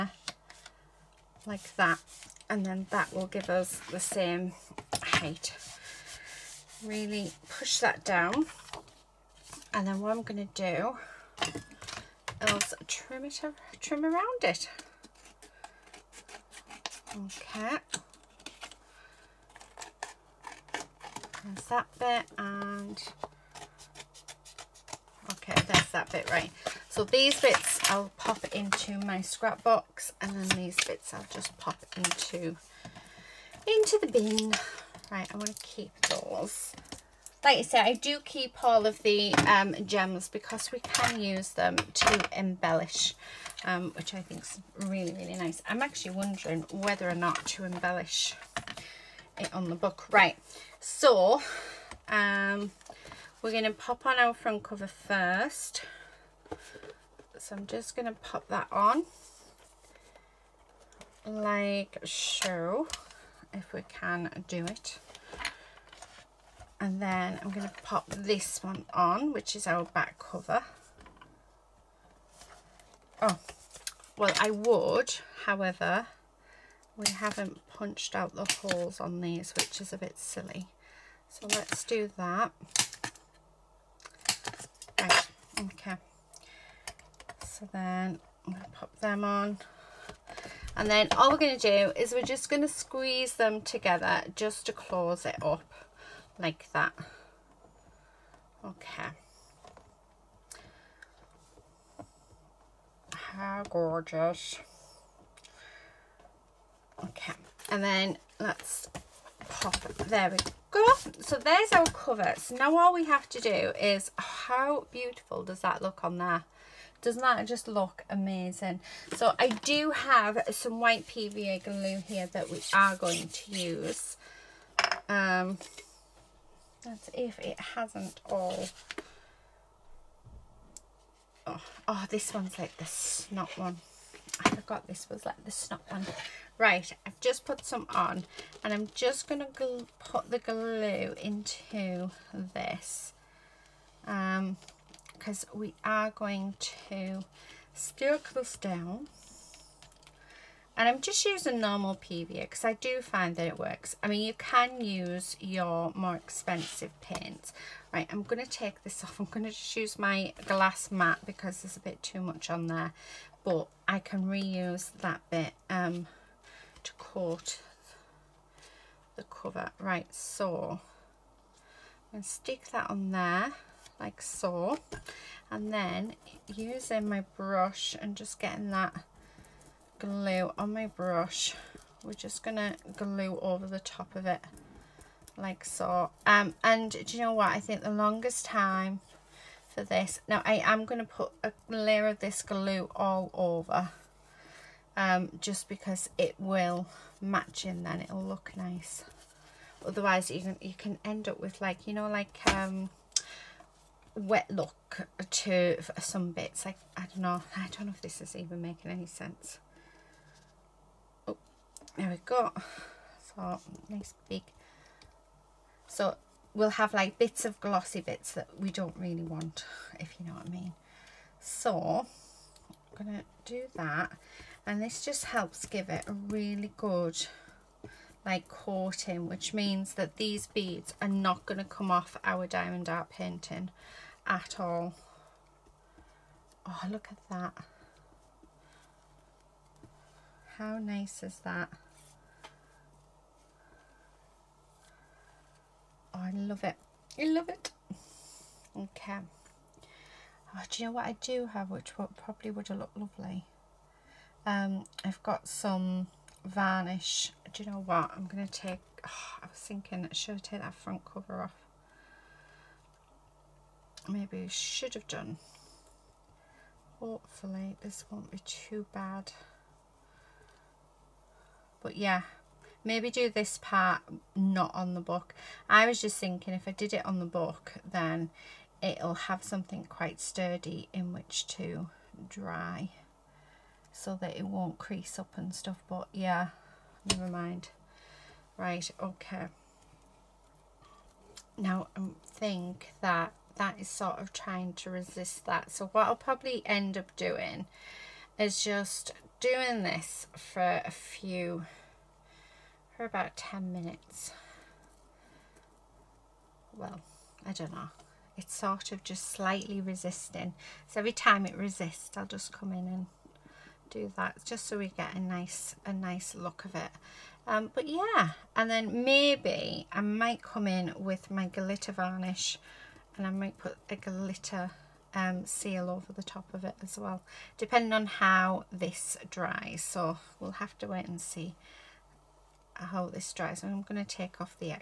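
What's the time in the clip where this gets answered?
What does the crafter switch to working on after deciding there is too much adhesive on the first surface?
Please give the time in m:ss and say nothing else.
2:40.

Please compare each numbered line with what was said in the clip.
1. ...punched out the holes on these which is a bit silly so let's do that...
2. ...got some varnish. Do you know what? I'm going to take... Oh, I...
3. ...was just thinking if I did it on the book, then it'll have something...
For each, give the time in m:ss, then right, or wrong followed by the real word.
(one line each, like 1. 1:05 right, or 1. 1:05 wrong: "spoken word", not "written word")
1. 1:17 right
2. 4:15 right
3. 4:35 right.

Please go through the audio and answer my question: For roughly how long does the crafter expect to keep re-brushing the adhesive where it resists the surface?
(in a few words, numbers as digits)
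about 10 minutes.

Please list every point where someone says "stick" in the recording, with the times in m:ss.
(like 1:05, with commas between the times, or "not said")
2:27, 2:52.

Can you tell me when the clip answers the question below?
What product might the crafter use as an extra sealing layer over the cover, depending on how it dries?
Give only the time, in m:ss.
5:21.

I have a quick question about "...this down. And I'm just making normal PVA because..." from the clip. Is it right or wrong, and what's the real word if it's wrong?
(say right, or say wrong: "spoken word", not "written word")
wrong: "using", not "making".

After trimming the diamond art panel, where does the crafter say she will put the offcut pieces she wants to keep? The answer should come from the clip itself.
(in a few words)
scrap box.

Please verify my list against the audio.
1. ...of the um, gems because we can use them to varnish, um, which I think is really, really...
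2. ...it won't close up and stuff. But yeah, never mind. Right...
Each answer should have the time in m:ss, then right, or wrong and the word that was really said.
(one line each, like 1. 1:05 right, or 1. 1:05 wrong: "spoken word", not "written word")
1. 0:38 wrong: "embellish", not "varnish"
2. 4:44 wrong: "crease", not "close".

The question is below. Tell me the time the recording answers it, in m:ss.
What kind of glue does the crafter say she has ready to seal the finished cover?
2:00.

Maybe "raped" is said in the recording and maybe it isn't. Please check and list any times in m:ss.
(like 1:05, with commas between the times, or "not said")
not said.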